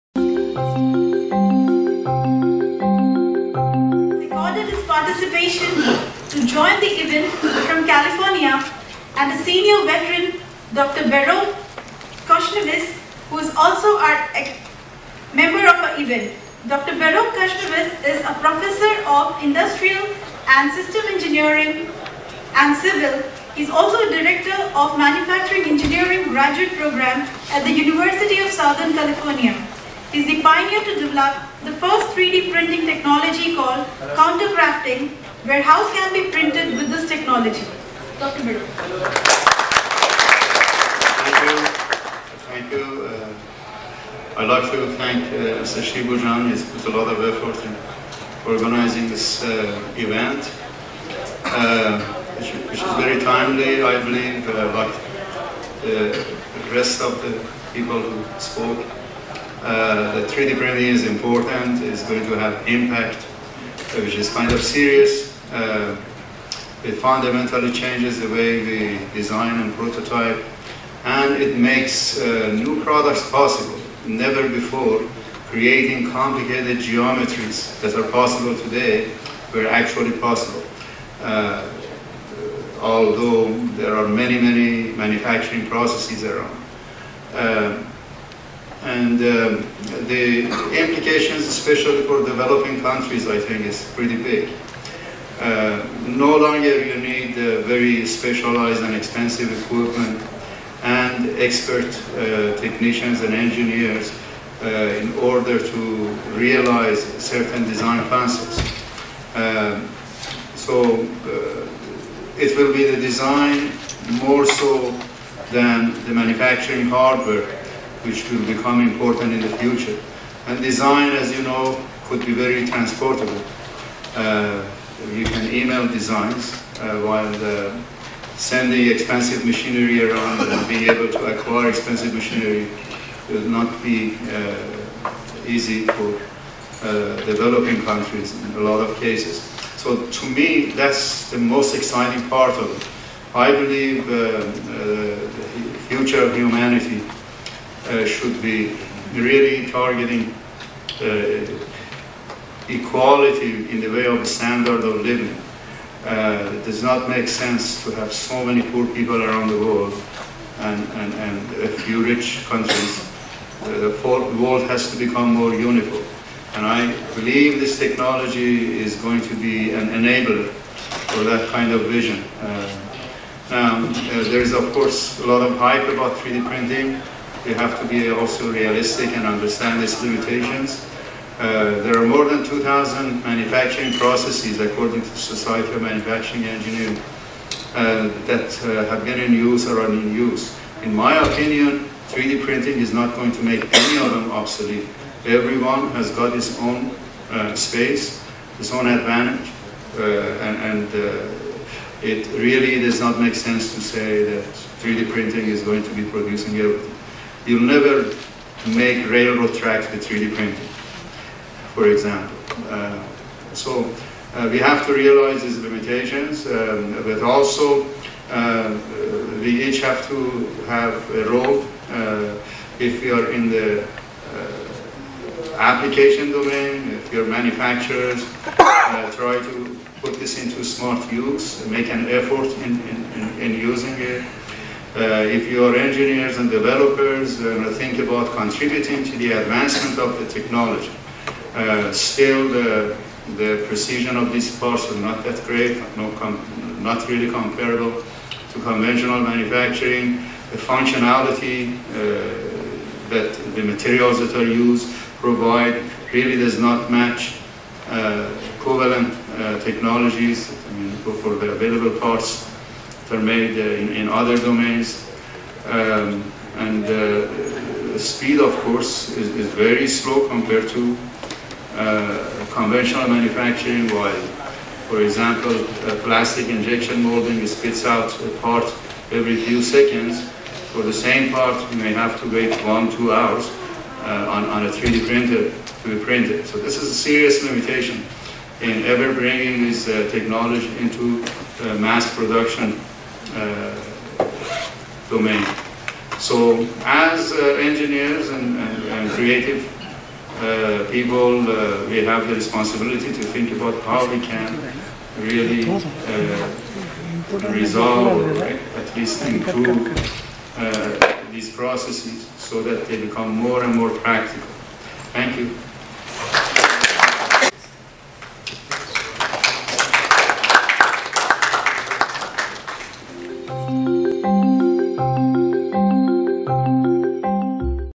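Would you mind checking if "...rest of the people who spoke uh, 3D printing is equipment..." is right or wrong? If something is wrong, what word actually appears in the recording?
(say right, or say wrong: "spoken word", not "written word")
wrong: "important", not "equipment".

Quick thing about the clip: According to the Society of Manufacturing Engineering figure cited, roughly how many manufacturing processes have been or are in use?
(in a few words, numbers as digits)
More than 2,000.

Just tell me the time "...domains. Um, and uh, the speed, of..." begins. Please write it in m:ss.
4:24.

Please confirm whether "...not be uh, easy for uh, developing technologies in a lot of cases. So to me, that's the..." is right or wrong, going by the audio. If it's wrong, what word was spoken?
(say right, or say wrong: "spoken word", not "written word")
wrong: "countries", not "technologies".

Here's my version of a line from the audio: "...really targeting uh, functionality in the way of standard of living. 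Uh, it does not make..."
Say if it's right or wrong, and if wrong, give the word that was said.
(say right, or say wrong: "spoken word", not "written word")
wrong: "equality", not "functionality".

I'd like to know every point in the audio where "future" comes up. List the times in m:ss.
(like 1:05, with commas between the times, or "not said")
1:59, 2:25.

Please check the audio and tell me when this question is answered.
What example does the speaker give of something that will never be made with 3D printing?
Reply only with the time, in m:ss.
3:29.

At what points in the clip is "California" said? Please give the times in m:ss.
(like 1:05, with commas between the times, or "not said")
0:07, 0:28.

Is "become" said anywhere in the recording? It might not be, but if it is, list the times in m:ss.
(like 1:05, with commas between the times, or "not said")
1:58, 2:44, 5:13.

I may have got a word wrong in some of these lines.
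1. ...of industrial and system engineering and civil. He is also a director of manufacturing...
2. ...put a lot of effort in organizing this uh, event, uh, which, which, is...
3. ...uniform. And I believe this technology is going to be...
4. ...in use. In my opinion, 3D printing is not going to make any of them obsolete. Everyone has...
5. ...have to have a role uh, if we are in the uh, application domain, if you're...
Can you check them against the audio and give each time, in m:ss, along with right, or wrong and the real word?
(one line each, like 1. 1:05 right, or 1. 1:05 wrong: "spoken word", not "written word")
1. 0:19 right
2. 0:46 right
3. 2:45 right
4. 3:09 right
5. 3:39 right.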